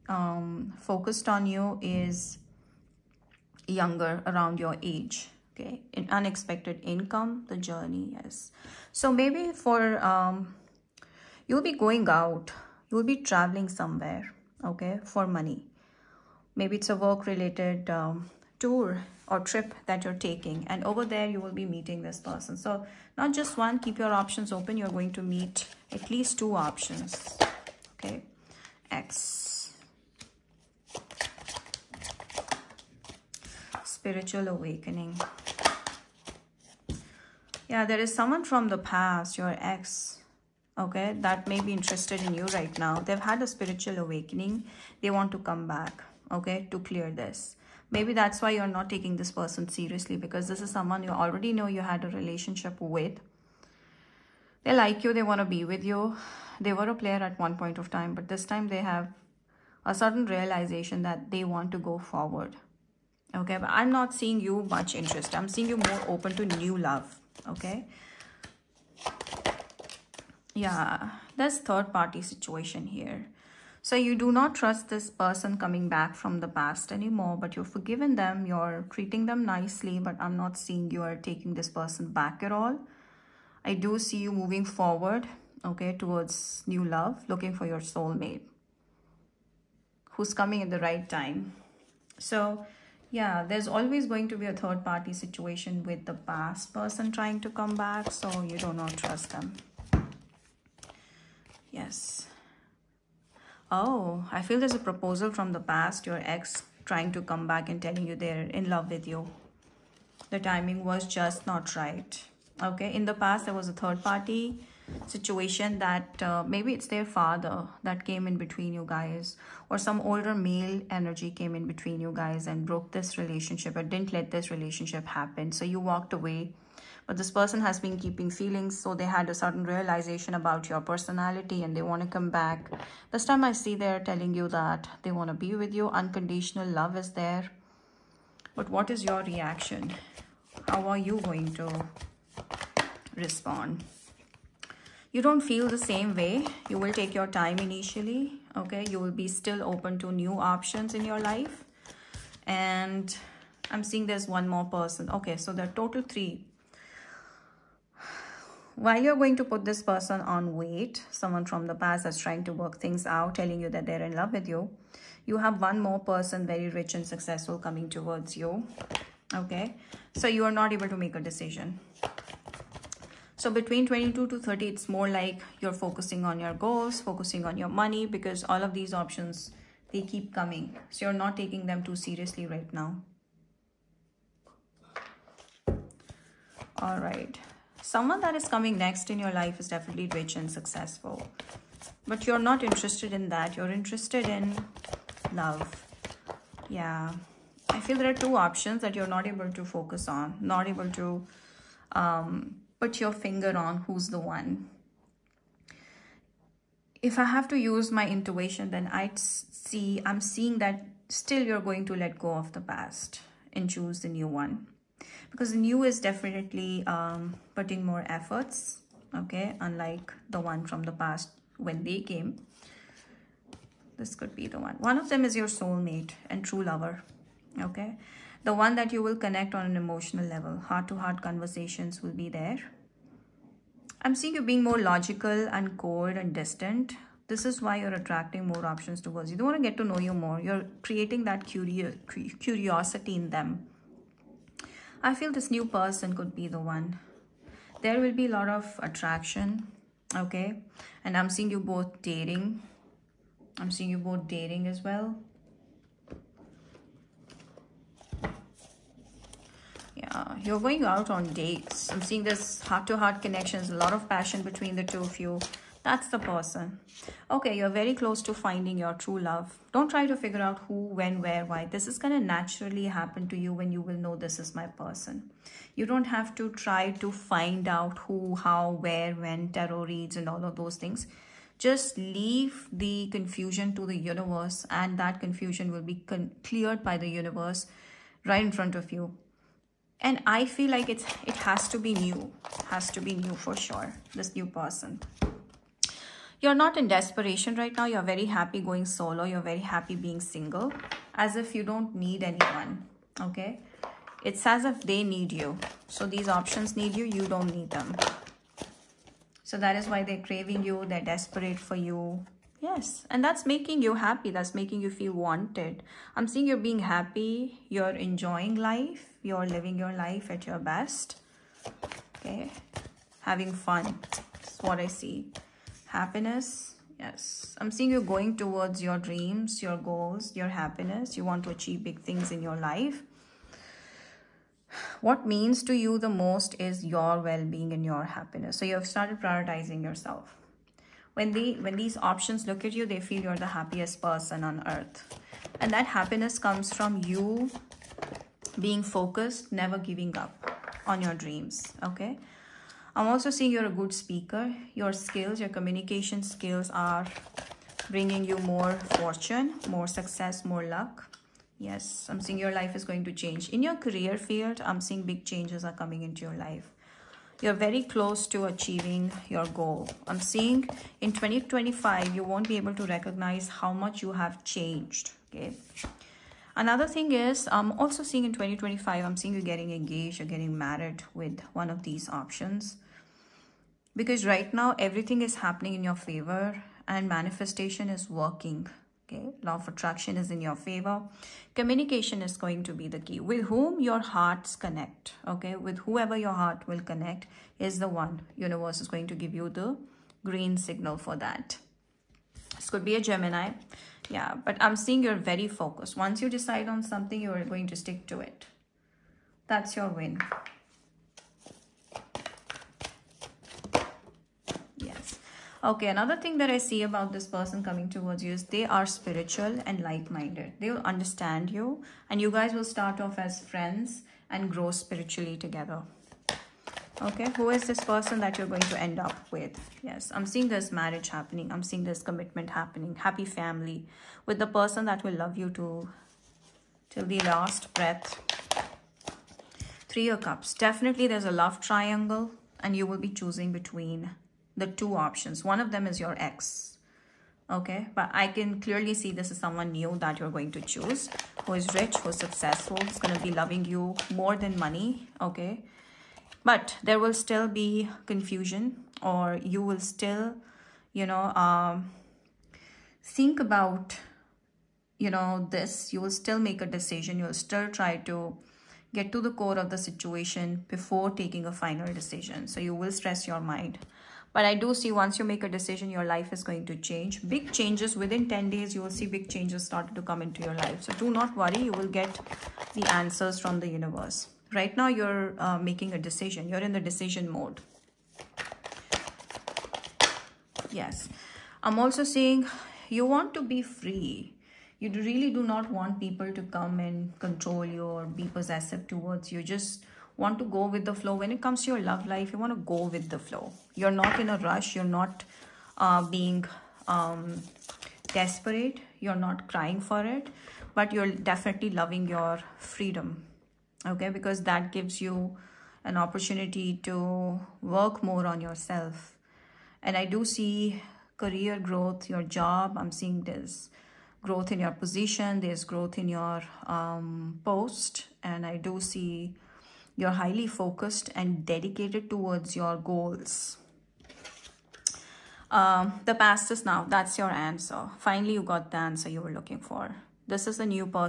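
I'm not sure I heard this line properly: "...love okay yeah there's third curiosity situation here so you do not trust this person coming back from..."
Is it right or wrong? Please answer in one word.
wrong.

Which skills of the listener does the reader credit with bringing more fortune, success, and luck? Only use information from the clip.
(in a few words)
Communication skills.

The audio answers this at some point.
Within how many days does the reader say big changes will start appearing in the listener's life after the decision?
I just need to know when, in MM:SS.
07:58.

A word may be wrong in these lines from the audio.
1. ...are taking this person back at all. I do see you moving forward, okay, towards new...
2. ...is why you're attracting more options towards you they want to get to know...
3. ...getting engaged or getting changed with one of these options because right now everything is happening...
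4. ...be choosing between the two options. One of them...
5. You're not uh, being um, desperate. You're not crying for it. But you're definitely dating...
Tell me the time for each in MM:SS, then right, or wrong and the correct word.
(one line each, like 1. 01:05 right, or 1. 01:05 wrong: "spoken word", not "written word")
1. 01:21 right
2. 03:57 right
3. 06:19 wrong: "married", not "changed"
4. 07:22 right
5. 08:24 wrong: "loving", not "dating".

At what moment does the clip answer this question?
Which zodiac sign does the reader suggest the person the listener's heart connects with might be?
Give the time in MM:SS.
06:43.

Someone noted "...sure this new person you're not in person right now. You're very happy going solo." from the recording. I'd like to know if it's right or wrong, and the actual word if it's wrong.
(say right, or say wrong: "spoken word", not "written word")
wrong: "desperation", not "person".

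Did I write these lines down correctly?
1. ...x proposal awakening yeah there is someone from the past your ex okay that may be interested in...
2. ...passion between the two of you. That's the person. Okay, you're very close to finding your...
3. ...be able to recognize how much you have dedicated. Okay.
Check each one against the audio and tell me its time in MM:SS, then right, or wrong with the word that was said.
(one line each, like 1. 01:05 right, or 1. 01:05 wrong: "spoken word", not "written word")
1. 00:28 wrong: "spiritual", not "proposal"
2. 04:24 right
3. 06:12 wrong: "changed", not "dedicated".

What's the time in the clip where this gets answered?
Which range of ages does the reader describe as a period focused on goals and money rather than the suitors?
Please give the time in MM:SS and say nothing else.
02:53.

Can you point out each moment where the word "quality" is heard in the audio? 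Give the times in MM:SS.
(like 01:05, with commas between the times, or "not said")
not said.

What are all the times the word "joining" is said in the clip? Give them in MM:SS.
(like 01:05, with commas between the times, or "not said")
not said.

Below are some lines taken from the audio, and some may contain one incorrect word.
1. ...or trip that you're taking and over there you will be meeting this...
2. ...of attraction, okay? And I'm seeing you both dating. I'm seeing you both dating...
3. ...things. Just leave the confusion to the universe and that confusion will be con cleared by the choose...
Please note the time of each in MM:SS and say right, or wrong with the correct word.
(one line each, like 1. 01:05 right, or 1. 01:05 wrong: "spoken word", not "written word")
1. 00:19 right
2. 04:08 right
3. 04:40 wrong: "universe", not "choose".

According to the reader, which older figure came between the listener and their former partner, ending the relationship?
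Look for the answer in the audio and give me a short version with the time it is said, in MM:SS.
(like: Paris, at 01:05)
Their father, at 01:56.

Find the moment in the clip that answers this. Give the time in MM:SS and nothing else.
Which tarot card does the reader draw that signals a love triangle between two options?
07:19.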